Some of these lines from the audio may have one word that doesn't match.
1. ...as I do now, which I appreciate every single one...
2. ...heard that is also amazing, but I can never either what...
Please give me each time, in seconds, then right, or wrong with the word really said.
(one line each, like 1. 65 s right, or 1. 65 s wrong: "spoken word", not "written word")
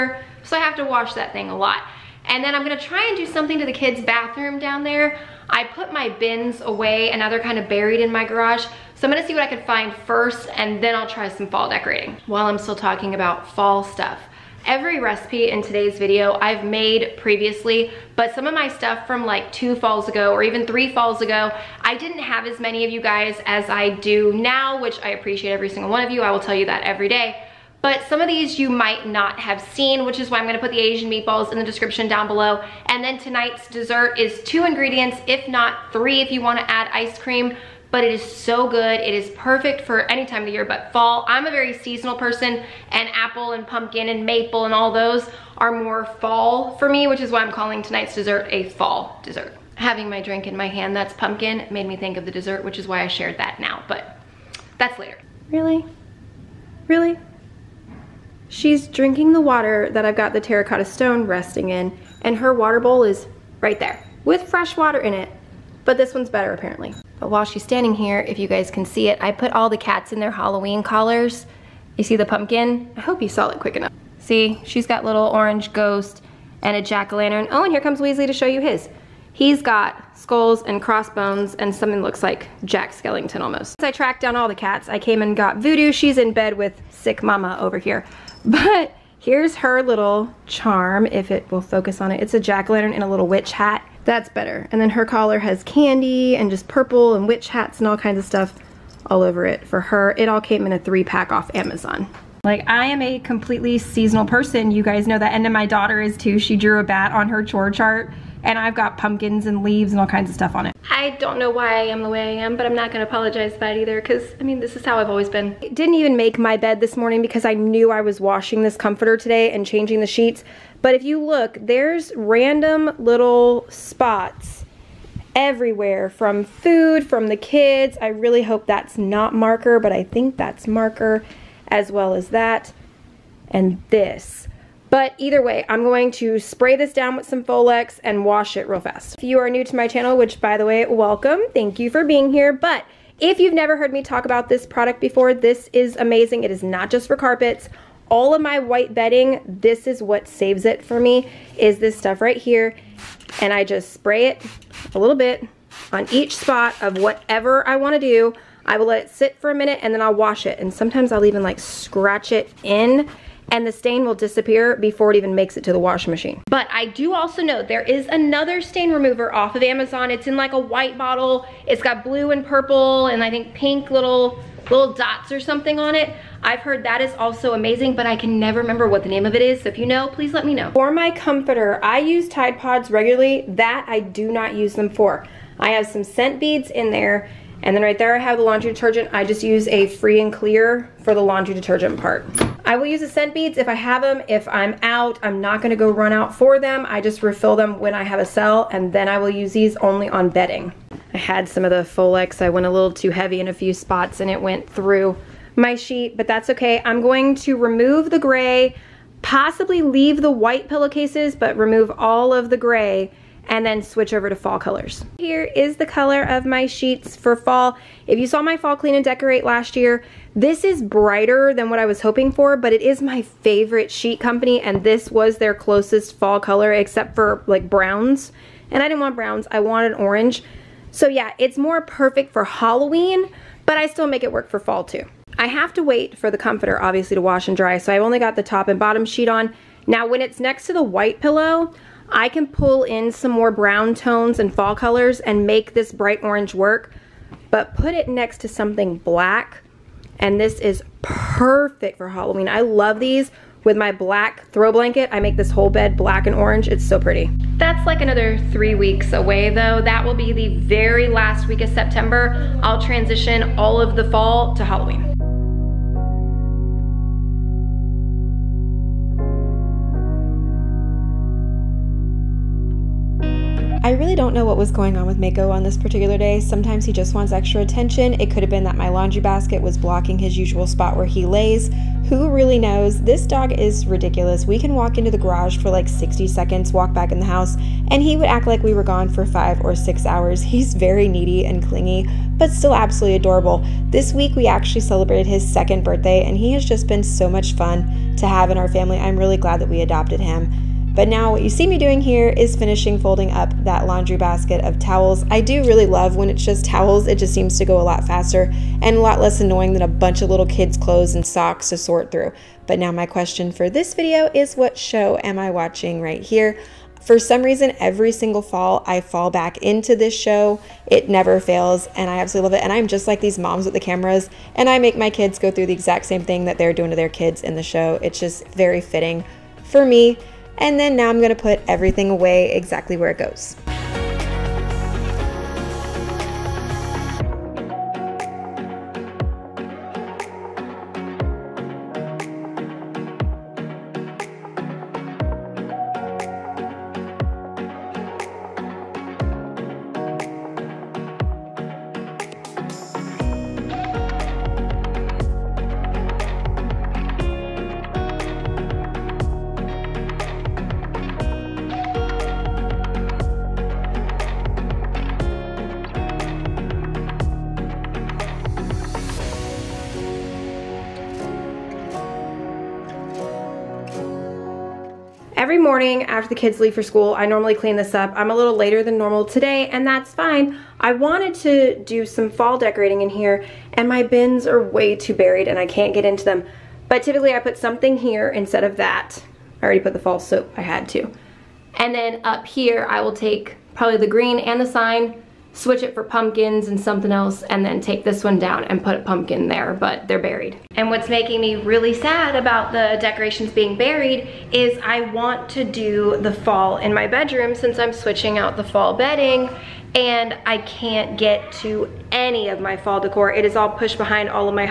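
1. 23 s right
2. 176 s wrong: "remember", not "either".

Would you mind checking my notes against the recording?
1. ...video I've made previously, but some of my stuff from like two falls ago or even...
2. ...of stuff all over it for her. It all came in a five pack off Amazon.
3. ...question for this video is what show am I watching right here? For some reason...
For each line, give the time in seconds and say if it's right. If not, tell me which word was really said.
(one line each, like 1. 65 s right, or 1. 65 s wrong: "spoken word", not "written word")
1. 15 s right
2. 98 s wrong: "three", not "five"
3. 313 s right.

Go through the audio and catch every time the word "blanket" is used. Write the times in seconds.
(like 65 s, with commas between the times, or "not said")
254 s.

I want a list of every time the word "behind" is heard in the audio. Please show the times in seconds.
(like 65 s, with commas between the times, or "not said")
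413 s.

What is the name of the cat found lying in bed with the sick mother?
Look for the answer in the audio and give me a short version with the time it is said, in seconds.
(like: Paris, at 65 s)
Voodoo, at 85 s.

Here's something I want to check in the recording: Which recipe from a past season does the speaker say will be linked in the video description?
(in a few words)
Asian meatballs.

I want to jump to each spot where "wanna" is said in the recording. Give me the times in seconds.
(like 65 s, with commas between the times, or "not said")
36 s, 157 s.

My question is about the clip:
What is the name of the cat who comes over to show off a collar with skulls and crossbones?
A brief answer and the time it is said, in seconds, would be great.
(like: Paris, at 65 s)
Weasley, at 77 s.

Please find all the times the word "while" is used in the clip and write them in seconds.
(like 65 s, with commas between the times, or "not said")
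12 s, 67 s.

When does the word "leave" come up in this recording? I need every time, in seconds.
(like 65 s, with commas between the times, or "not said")
109 s, 209 s, 376 s.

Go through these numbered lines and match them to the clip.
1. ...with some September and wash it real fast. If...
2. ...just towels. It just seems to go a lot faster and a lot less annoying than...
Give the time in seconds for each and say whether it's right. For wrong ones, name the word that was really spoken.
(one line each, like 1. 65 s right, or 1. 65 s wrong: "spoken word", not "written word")
1. 137 s wrong: "Folex", not "September"
2. 306 s right.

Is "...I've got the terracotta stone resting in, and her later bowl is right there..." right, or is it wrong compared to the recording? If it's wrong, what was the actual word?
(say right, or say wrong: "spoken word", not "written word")
wrong: "water", not "later".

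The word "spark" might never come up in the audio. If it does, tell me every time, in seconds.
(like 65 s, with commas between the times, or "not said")
not said.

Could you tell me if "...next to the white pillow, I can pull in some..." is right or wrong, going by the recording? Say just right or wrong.
right.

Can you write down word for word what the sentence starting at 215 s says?
Here is the color of my sheets for fall.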